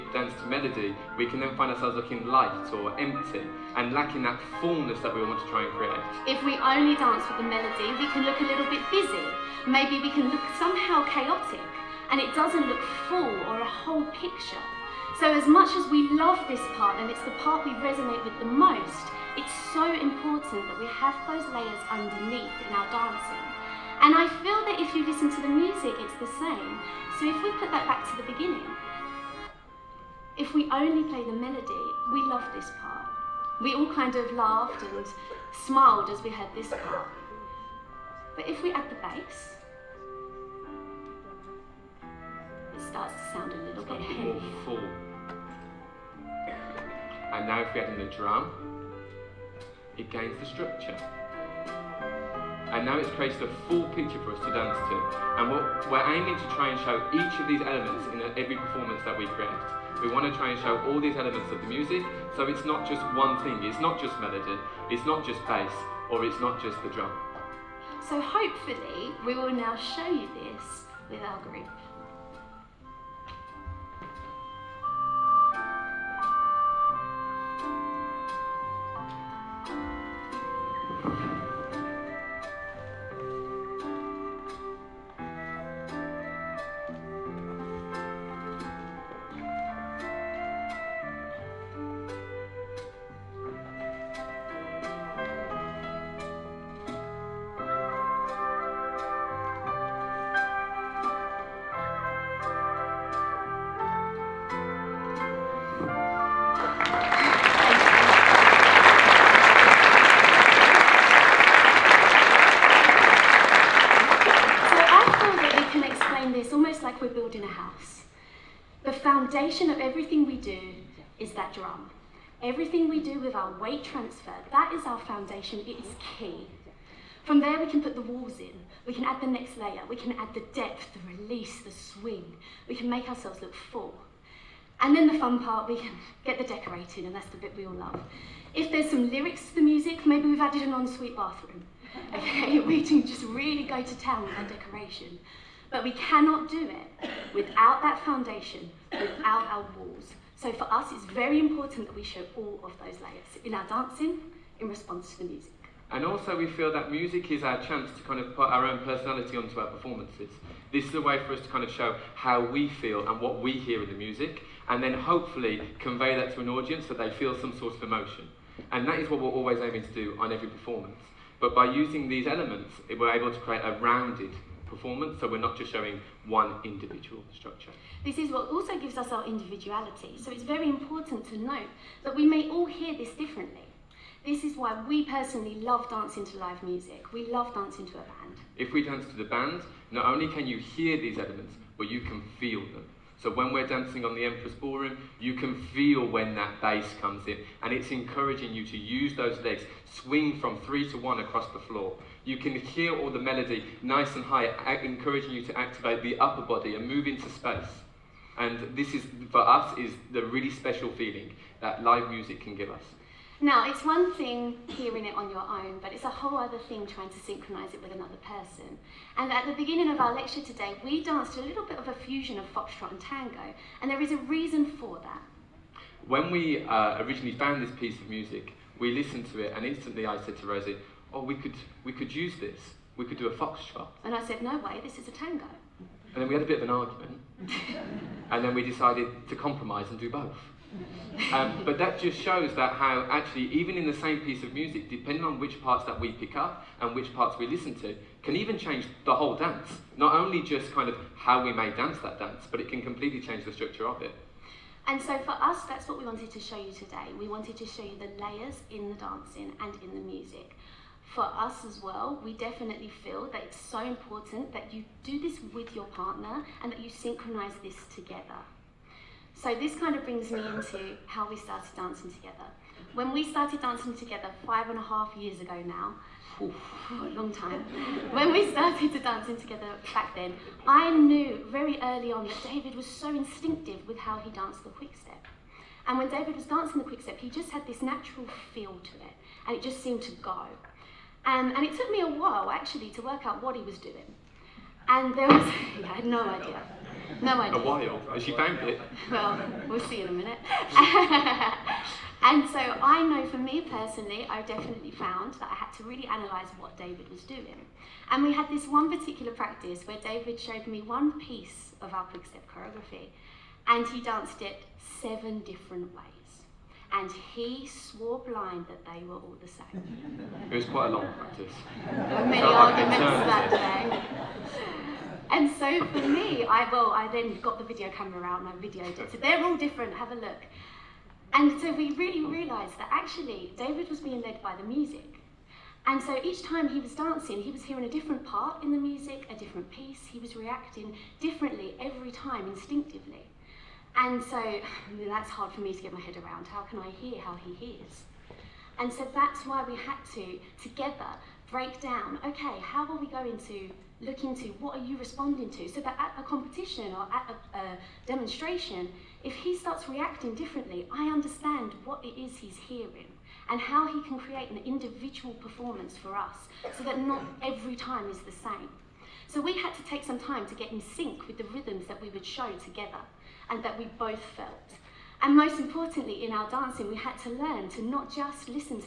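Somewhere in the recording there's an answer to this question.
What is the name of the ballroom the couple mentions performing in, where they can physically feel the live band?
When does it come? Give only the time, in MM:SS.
03:14.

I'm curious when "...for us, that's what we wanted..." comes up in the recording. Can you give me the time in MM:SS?
04:15.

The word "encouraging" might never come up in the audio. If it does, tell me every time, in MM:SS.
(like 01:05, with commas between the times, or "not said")
03:17, 03:24.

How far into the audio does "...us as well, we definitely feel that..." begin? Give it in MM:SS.
04:21.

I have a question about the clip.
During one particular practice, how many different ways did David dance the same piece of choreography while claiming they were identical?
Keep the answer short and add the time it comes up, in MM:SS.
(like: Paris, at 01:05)
7, at 05:15.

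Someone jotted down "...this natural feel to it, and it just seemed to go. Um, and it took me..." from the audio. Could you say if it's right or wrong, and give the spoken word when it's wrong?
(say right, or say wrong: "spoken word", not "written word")
right.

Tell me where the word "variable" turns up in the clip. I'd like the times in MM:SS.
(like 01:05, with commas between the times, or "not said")
not said.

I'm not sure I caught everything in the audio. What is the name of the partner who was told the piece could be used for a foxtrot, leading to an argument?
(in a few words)
Rosie.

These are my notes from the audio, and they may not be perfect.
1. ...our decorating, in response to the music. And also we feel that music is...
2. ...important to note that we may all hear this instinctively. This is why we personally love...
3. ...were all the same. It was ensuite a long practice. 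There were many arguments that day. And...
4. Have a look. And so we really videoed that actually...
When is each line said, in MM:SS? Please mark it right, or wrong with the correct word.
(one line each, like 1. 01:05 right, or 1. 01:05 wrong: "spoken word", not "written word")
1. 02:33 wrong: "dancing", not "decorating"
2. 03:00 wrong: "differently", not "instinctively"
3. 05:19 wrong: "quite", not "ensuite"
4. 05:29 wrong: "realised", not "videoed".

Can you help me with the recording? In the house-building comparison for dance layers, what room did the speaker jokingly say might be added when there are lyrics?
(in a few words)
ensuite bathroom.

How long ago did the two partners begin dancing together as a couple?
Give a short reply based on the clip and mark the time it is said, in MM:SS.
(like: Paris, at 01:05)
5 and a half years, at 04:34.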